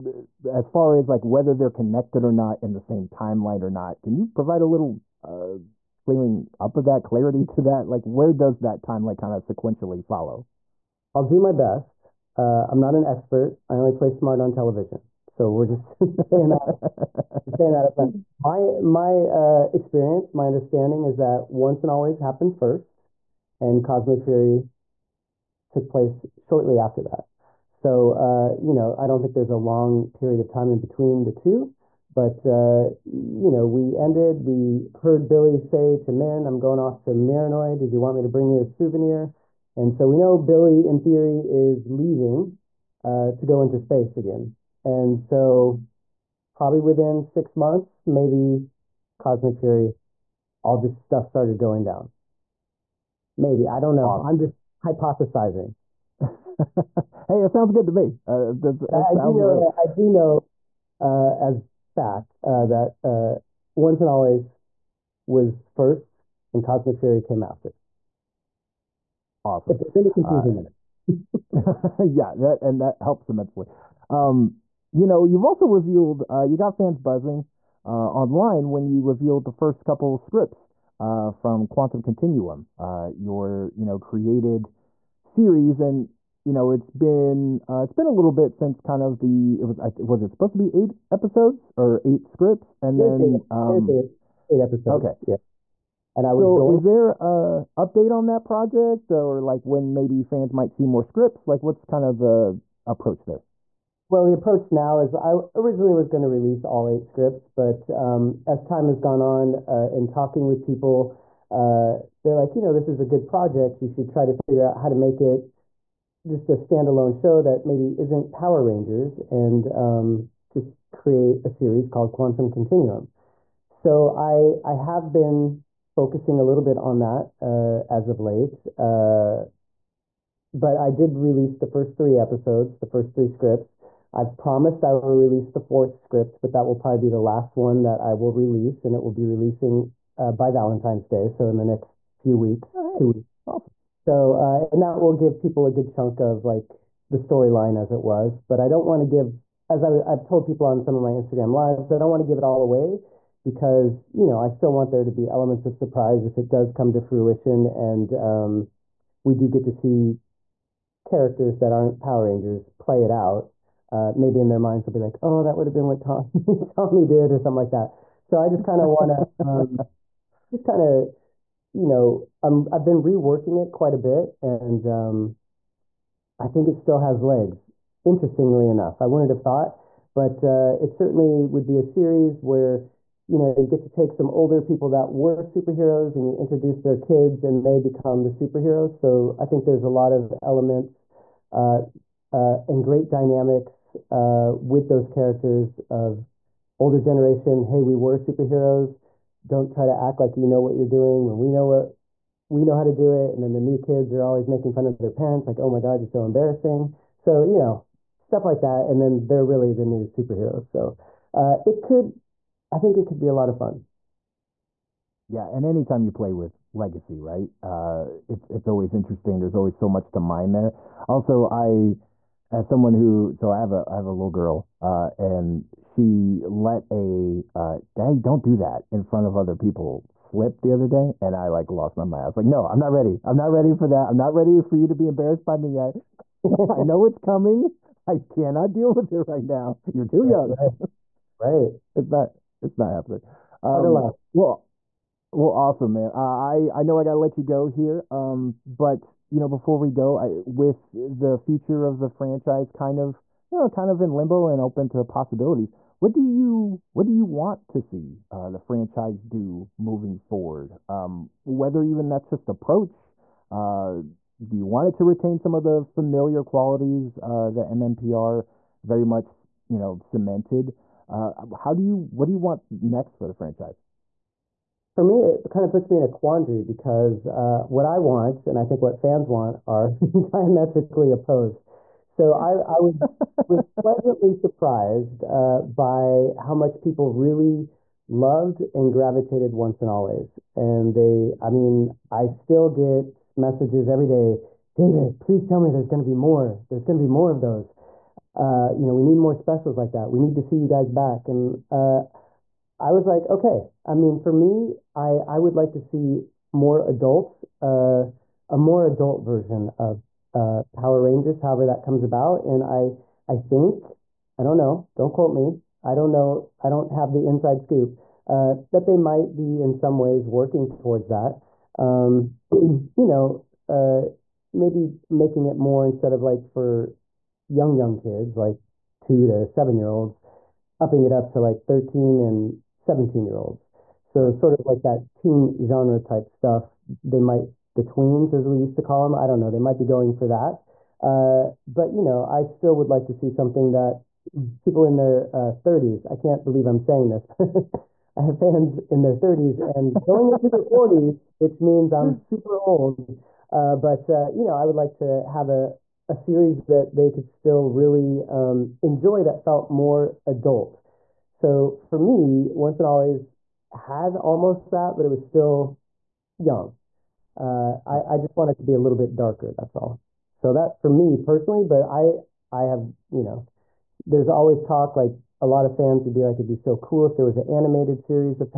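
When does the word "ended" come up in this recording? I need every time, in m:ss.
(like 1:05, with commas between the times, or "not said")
0:33.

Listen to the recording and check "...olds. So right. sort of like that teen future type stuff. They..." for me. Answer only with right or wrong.
wrong.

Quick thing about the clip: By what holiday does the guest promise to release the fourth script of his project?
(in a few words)
Valentine's Day.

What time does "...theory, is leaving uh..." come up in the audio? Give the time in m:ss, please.
0:40.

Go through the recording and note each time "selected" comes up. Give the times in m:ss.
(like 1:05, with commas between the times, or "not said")
not said.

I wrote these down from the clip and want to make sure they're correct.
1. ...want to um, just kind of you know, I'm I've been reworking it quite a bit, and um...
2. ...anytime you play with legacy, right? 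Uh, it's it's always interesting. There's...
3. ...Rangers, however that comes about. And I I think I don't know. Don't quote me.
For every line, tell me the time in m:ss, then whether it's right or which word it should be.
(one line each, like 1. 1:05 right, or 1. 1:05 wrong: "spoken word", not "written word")
1. 2:48 right
2. 3:35 right
3. 5:11 right.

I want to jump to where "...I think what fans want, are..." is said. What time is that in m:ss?
4:38.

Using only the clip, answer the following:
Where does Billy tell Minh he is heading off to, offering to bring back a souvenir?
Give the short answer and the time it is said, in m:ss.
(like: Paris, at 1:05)
Marinoid, at 0:37.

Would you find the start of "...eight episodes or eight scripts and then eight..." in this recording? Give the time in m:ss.
1:30.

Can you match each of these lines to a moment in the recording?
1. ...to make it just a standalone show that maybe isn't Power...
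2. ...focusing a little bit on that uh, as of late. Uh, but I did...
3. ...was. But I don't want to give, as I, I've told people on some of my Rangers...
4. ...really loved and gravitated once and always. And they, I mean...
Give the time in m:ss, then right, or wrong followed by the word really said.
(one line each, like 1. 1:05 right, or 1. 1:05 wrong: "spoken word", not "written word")
1. 1:54 right
2. 2:05 right
3. 2:28 wrong: "Instagram", not "Rangers"
4. 4:47 right.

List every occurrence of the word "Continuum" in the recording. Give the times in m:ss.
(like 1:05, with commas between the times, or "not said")
1:22, 2:02.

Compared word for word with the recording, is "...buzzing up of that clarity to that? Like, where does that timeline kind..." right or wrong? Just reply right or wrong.
wrong.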